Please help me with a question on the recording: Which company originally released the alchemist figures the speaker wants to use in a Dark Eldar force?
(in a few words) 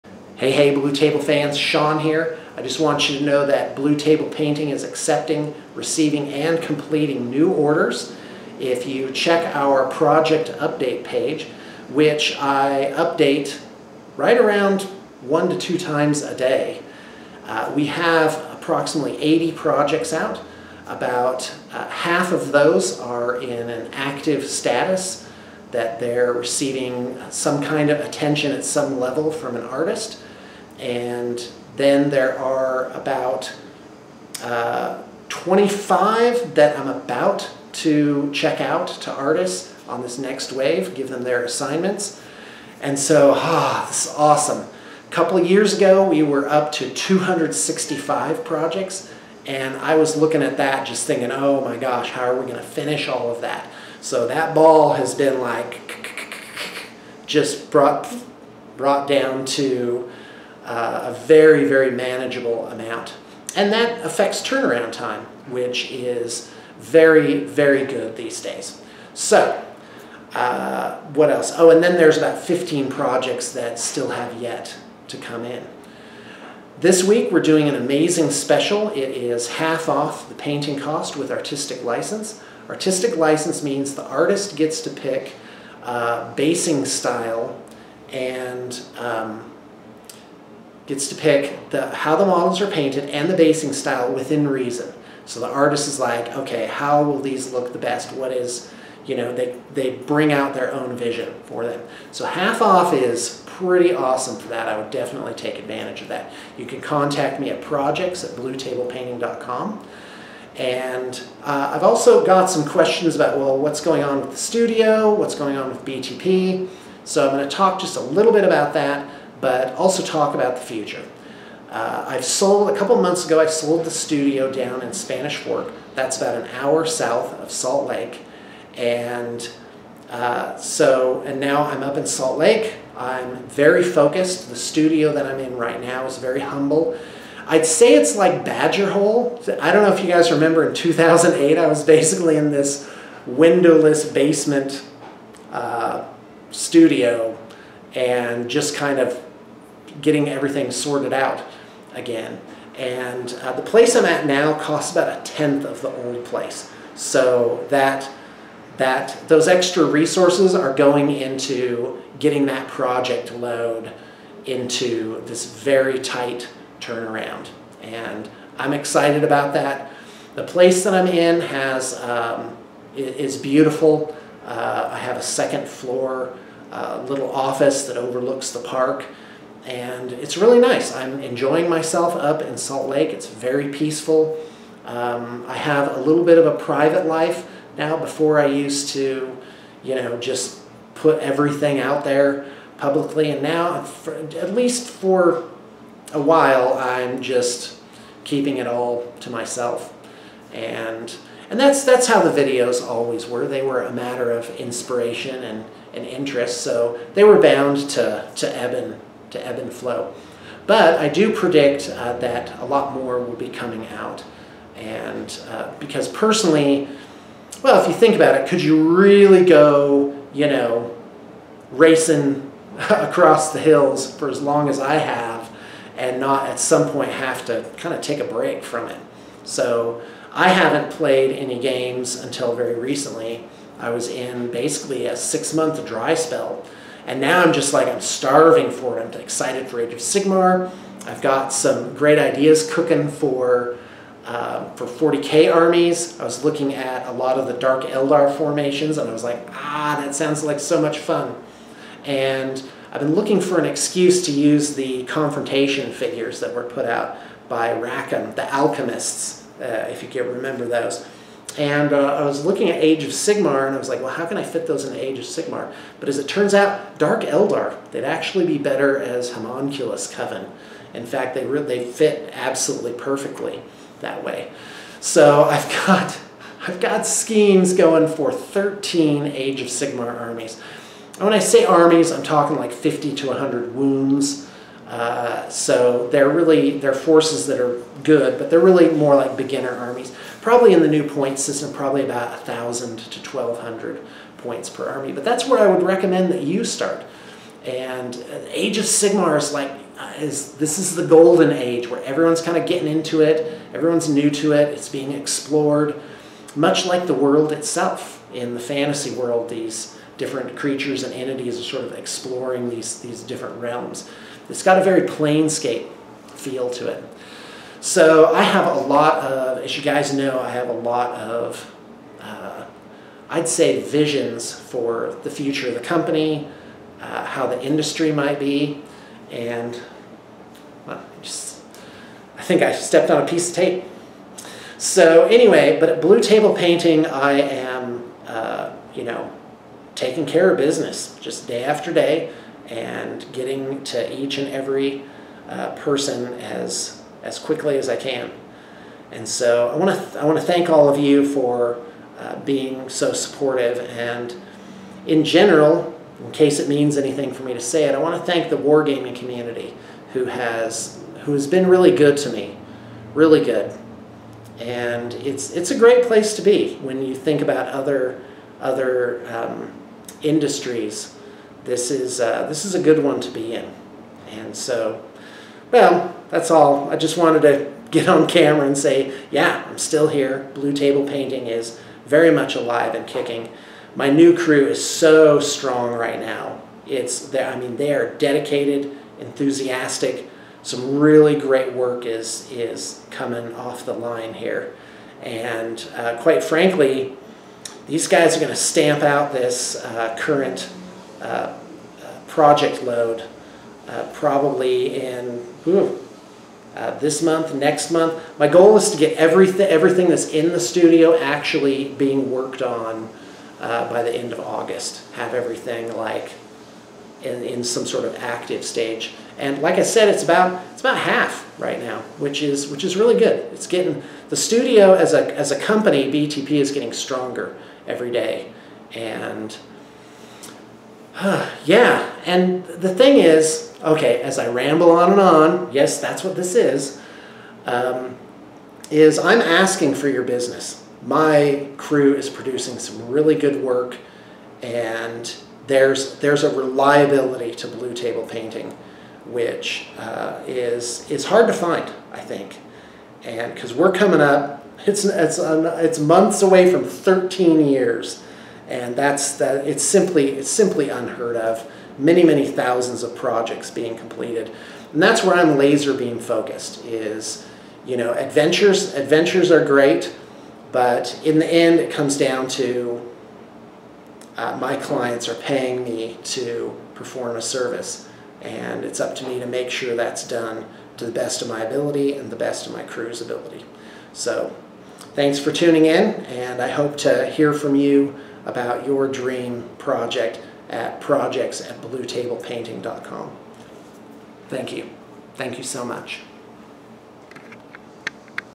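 Rackham.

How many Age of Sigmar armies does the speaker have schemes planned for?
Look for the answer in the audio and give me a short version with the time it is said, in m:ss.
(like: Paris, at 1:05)
13, at 4:38.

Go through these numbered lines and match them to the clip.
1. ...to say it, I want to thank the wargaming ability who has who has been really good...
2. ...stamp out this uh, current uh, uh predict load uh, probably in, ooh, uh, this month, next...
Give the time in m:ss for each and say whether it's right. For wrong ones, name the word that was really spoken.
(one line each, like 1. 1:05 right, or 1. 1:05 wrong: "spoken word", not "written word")
1. 5:57 wrong: "community", not "ability"
2. 6:38 wrong: "project", not "predict".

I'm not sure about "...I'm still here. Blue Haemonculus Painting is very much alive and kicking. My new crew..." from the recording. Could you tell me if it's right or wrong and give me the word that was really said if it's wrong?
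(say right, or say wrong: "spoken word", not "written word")
wrong: "Table", not "Haemonculus".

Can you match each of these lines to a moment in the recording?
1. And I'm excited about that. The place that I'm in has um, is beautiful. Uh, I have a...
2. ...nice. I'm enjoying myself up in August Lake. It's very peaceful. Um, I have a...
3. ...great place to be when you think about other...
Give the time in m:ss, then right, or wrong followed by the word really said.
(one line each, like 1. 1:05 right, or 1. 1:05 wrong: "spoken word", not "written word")
1. 2:47 right
2. 3:00 wrong: "Salt", not "August"
3. 6:05 right.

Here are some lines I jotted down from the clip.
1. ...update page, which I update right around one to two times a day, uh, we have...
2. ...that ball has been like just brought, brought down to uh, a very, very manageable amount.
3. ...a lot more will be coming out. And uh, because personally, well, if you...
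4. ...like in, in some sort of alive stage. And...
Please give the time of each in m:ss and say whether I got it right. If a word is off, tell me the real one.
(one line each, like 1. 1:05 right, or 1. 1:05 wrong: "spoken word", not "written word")
1. 0:10 right
2. 0:54 right
3. 3:32 right
4. 6:55 wrong: "active", not "alive".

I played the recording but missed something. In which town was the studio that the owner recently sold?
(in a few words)
Spanish Fork.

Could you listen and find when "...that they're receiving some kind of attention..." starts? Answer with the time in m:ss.
0:25.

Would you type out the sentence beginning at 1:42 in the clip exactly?
So half off is pretty awesome for that.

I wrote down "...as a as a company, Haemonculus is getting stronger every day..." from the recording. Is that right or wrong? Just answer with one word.
wrong.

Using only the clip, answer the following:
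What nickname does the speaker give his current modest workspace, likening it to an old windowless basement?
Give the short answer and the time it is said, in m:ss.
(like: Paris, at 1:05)
Badger Hole, at 2:18.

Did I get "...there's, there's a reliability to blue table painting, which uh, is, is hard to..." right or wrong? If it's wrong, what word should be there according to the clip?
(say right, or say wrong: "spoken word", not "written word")
right.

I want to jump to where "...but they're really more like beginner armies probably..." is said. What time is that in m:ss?
4:48.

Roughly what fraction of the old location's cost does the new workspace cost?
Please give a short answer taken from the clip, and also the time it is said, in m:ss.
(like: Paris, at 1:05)
a tenth, at 2:35.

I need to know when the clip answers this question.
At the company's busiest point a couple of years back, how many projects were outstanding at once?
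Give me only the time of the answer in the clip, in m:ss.
0:46.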